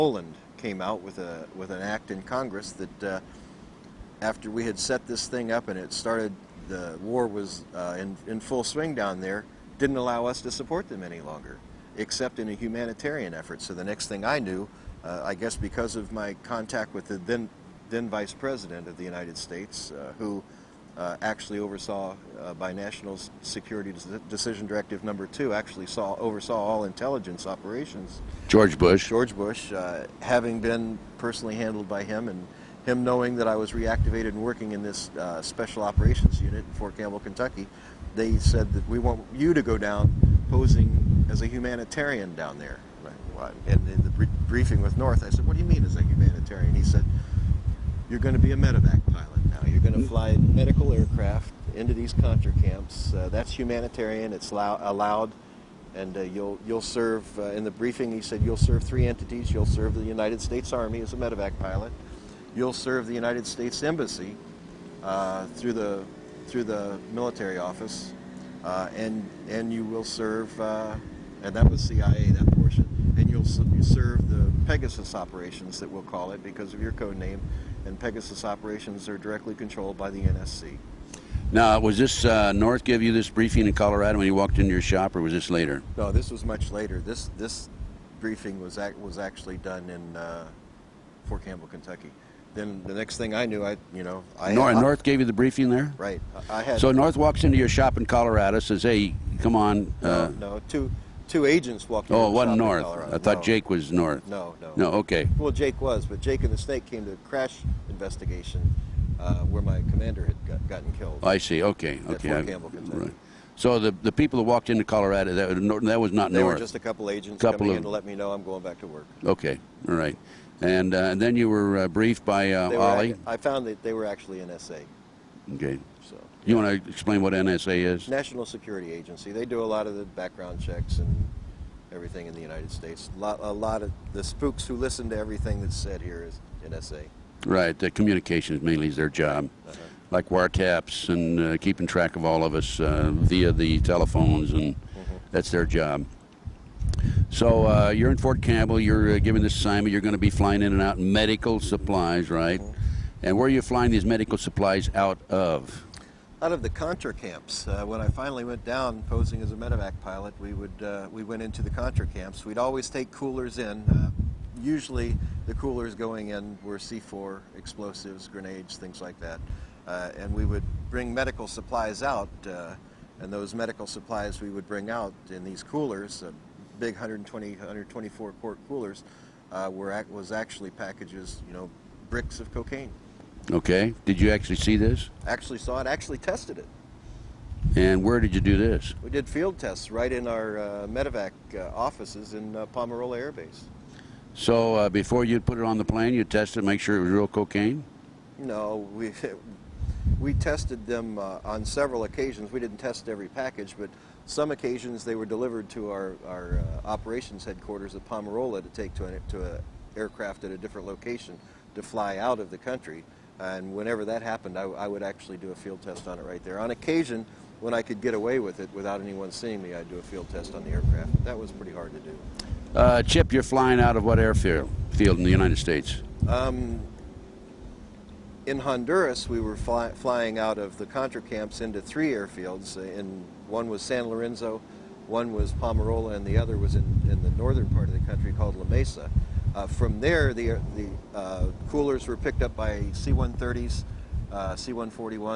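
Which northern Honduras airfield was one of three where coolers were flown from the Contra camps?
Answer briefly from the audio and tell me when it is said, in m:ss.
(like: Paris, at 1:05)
La Mesa, at 3:58.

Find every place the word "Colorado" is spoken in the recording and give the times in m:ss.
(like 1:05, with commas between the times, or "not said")
1:23, 1:38, 1:54.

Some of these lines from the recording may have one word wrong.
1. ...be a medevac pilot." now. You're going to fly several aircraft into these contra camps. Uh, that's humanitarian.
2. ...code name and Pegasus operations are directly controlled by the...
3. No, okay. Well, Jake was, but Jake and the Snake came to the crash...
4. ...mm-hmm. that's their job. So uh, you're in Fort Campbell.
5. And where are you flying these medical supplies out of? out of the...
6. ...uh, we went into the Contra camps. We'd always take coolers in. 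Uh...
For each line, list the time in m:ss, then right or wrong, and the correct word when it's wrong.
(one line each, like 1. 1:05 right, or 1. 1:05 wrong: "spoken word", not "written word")
1. 0:48 wrong: "medical", not "several"
2. 1:16 right
3. 1:44 right
4. 2:24 right
5. 2:33 right
6. 2:40 right.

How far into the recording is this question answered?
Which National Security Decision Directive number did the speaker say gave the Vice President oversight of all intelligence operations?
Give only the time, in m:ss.
0:25.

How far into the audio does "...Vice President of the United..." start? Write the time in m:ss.
0:18.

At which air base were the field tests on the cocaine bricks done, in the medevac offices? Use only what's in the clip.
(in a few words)
Palmerola Air Base.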